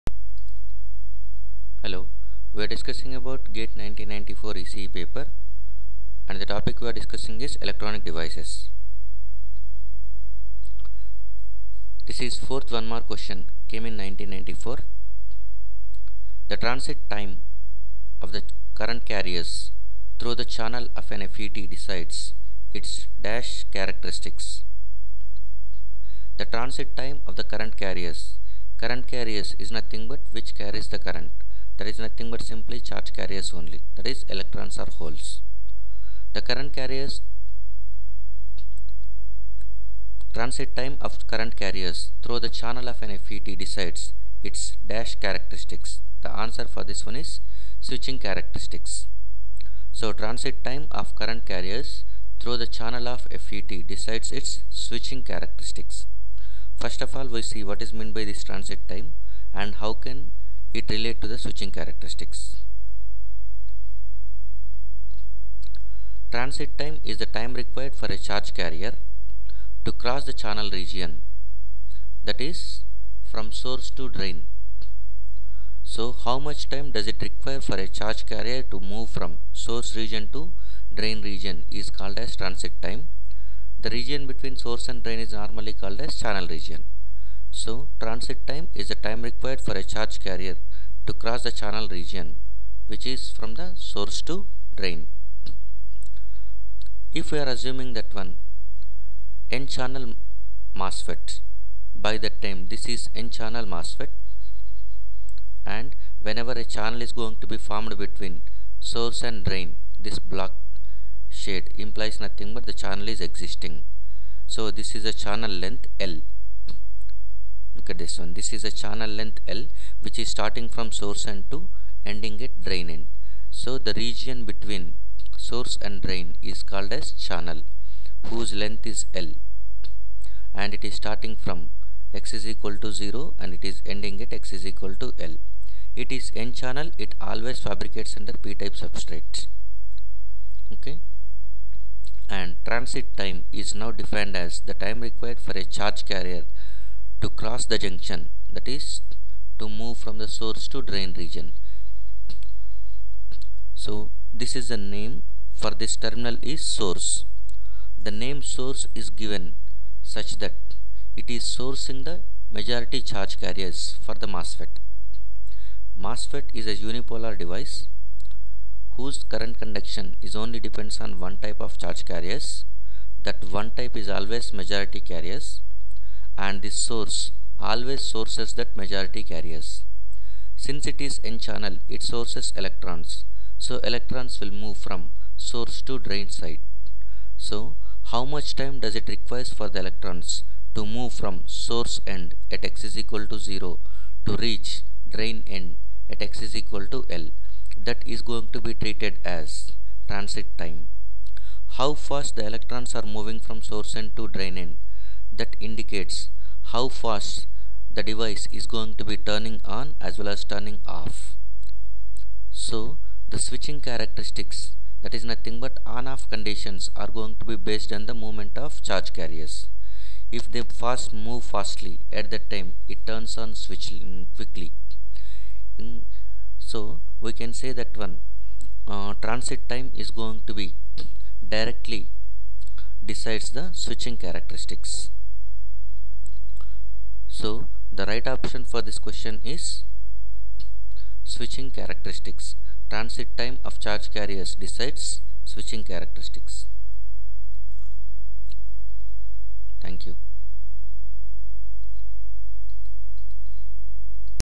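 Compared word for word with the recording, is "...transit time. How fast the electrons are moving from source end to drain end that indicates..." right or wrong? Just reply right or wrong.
right.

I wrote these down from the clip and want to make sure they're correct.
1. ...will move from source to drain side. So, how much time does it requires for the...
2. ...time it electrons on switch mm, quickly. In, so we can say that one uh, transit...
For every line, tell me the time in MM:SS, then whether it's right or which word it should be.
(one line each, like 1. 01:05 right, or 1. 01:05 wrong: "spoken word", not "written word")
1. 03:04 right
2. 03:42 wrong: "turns", not "electrons".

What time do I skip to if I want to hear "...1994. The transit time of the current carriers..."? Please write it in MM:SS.
00:13.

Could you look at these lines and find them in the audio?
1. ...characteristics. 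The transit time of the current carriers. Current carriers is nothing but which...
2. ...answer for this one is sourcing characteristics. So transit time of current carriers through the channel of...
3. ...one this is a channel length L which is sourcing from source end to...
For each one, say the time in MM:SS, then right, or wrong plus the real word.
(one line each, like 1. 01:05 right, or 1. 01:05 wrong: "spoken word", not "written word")
1. 00:23 right
2. 00:46 wrong: "switching", not "sourcing"
3. 01:58 wrong: "starting", not "sourcing".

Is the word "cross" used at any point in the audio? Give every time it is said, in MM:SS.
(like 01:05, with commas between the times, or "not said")
01:09, 01:31, 02:27.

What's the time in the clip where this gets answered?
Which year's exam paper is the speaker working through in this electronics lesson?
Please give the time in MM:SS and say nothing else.
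00:03.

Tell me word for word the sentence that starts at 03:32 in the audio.
So the switching characteristics that is nothing but on off conditions are going to be based on the movement of charge carriers.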